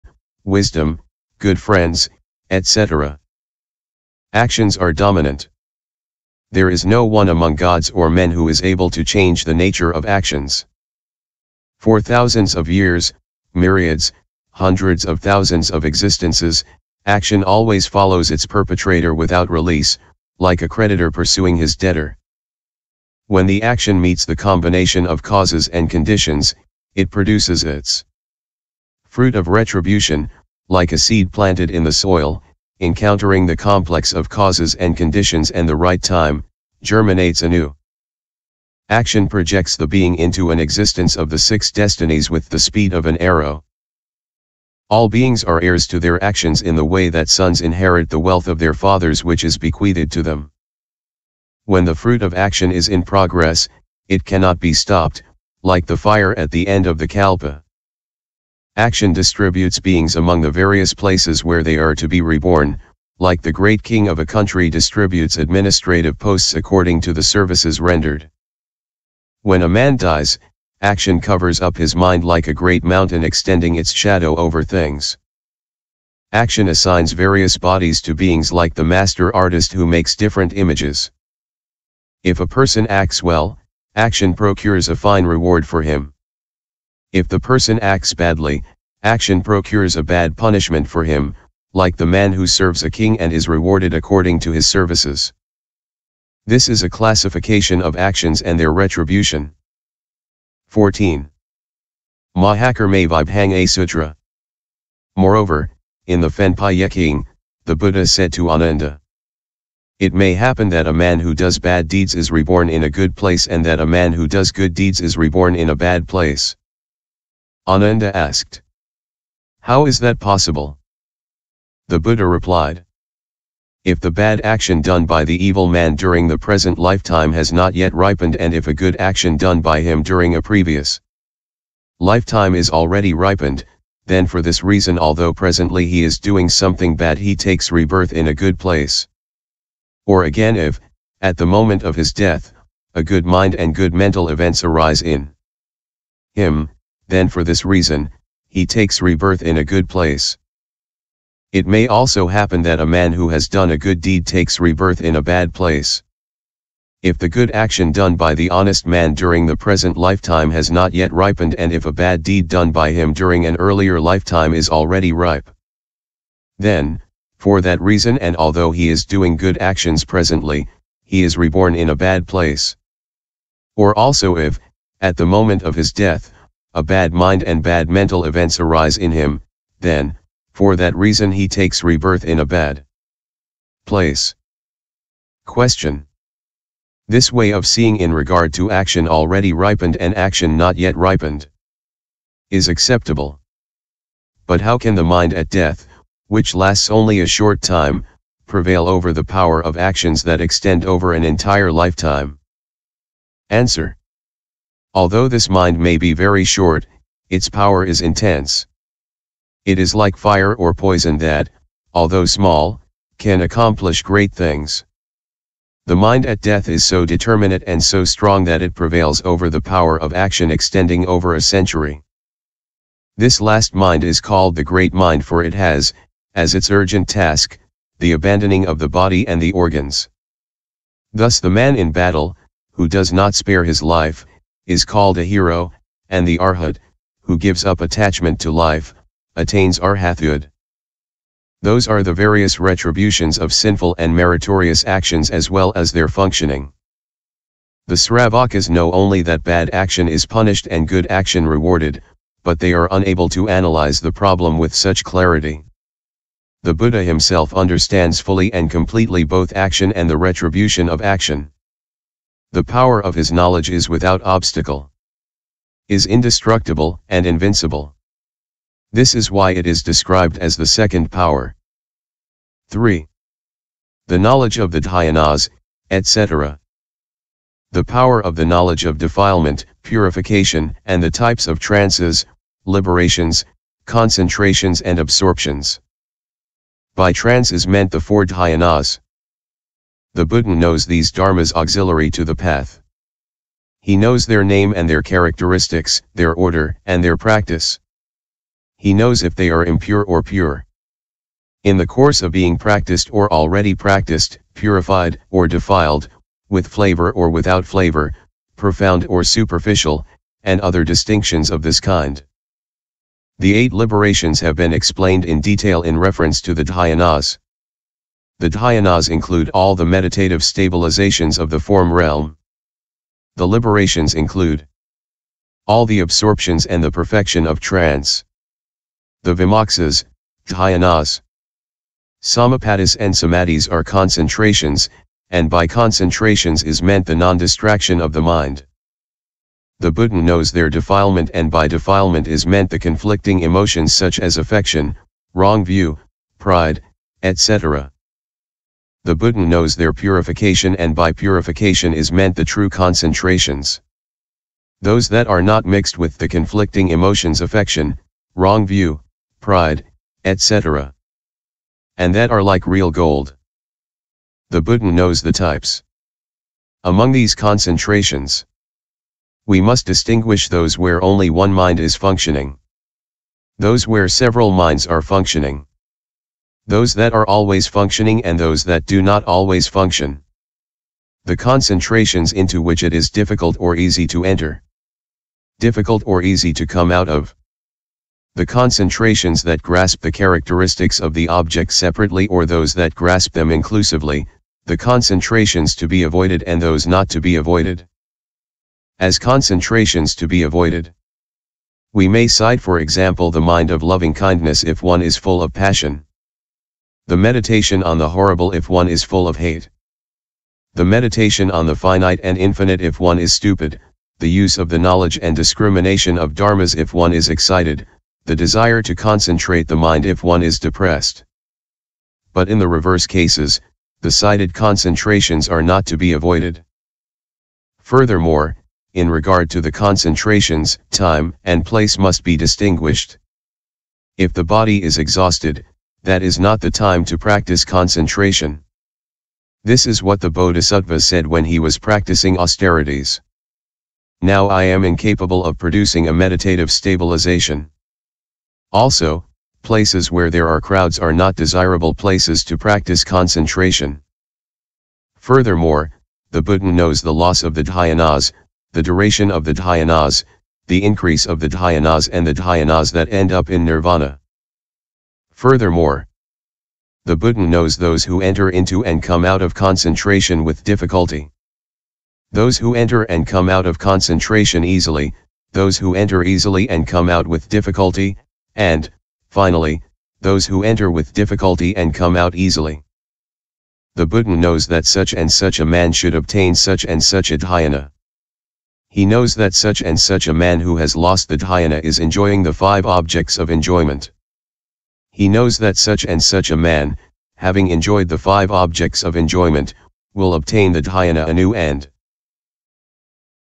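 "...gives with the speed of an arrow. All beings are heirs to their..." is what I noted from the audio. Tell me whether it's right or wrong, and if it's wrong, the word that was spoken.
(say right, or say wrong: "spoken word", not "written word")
wrong: "destinies", not "gives".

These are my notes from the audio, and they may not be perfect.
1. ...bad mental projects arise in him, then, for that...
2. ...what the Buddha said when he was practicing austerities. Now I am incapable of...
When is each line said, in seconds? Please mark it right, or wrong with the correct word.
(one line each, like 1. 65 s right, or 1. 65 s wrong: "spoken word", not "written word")
1. 177 s wrong: "events", not "projects"
2. 440 s wrong: "Bodhisattva", not "Buddha".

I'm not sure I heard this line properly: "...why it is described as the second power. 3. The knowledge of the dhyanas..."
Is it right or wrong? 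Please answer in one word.
right.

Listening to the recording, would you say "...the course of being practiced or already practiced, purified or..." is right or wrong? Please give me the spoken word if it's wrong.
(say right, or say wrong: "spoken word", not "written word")
right.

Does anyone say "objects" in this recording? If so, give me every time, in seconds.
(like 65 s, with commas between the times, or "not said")
391 s, 492 s, 498 s.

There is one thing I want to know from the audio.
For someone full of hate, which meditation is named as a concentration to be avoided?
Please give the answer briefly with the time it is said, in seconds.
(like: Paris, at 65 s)
meditation on the horrible, at 407 s.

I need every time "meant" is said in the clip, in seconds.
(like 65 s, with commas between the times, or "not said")
287 s, 336 s, 342 s, 352 s.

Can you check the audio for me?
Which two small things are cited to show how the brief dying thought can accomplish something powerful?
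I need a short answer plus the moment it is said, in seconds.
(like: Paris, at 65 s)
fire or poison, at 210 s.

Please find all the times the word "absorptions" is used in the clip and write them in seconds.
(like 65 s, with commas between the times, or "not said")
284 s, 325 s.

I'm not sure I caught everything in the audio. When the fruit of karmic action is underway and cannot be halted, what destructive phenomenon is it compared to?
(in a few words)
fire at the end of the kalpa.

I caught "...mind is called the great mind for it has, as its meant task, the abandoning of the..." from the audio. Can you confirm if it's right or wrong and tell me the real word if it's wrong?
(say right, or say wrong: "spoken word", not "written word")
wrong: "urgent", not "meant".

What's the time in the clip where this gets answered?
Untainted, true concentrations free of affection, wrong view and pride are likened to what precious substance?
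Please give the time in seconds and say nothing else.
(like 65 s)
362 s.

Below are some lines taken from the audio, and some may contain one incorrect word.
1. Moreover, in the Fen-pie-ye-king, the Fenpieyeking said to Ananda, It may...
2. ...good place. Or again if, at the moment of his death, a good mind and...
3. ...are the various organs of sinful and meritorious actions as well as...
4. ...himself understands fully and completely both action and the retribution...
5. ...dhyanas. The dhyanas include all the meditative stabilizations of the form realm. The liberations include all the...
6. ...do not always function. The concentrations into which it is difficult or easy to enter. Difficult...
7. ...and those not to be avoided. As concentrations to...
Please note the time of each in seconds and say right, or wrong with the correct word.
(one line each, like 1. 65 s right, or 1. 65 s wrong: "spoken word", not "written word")
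1. 105 s wrong: "Buddha", not "Fenpieyeking"
2. 138 s right
3. 241 s wrong: "retributions", not "organs"
4. 257 s right
5. 316 s right
6. 378 s right
7. 396 s right.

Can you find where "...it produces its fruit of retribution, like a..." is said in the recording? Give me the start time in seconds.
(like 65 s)
26 s.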